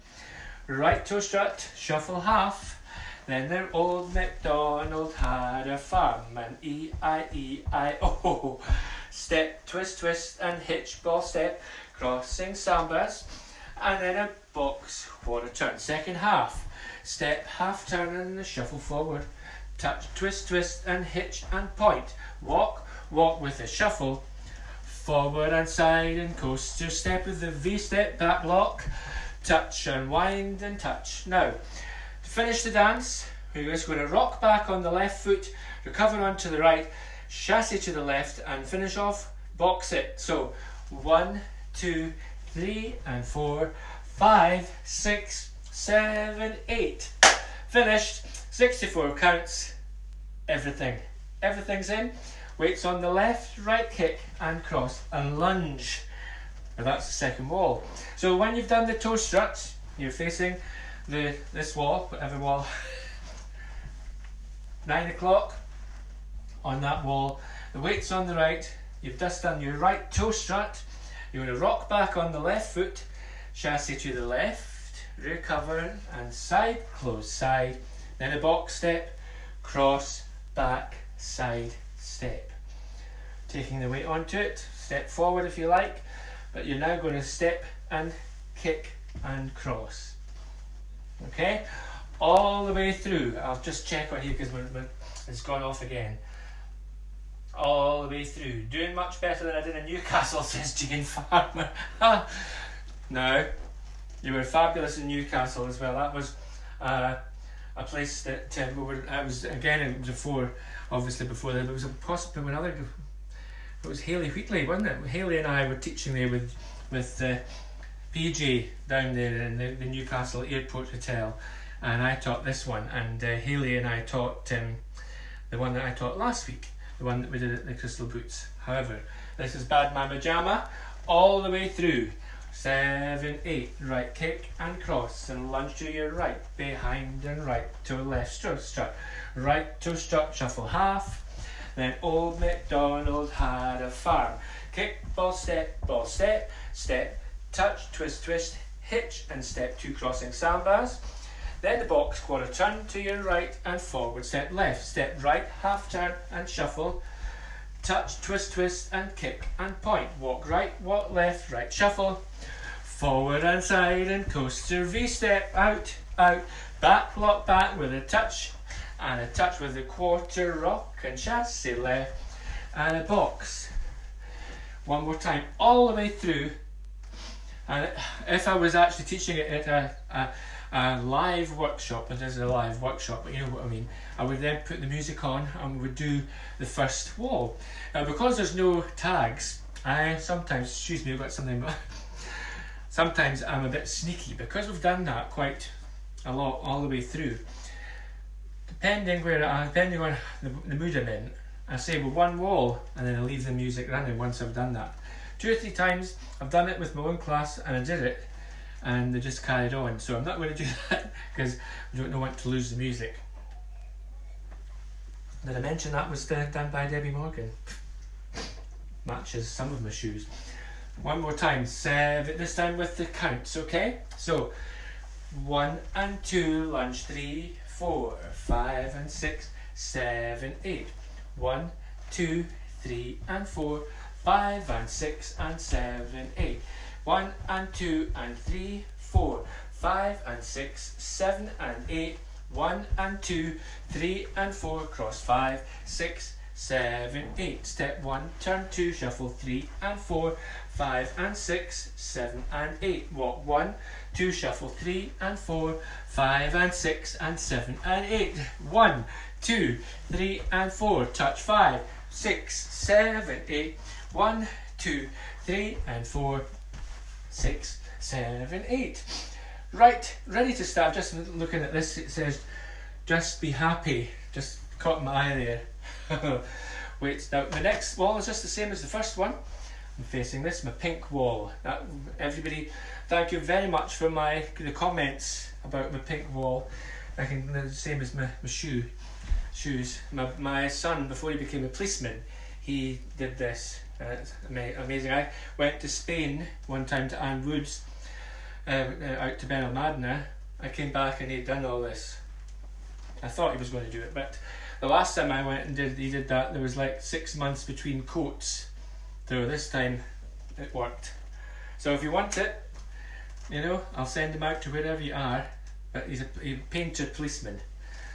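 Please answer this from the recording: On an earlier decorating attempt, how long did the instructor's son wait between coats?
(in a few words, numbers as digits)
6 months.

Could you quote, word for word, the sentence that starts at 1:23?
Taking the weight onto it, step forward if you like, but you're now going to step and kick and cross okay?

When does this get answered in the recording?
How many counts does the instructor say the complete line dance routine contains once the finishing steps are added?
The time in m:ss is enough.
0:48.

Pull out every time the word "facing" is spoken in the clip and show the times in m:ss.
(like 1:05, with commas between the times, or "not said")
1:00, 4:40.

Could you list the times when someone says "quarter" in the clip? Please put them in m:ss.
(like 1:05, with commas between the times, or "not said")
2:32, 2:49.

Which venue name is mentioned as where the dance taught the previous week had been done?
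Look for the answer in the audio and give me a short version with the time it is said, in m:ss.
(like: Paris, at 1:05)
Crystal Boots, at 2:07.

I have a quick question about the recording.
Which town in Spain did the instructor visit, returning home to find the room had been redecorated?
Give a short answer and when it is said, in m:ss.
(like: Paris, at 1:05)
Benalmádena, at 4:59.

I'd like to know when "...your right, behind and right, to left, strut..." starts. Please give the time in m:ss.
2:15.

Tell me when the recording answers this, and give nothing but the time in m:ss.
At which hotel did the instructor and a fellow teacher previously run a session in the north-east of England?
1:59.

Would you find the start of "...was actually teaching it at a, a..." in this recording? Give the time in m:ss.
2:58.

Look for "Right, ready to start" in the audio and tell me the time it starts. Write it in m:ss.
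4:29.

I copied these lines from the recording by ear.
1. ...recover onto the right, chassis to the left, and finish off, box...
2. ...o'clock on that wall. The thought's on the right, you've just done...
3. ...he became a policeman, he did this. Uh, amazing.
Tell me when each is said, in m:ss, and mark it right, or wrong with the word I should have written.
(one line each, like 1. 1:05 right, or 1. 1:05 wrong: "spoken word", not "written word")
1. 0:35 right
2. 1:05 wrong: "weight", not "thought"
3. 4:51 right.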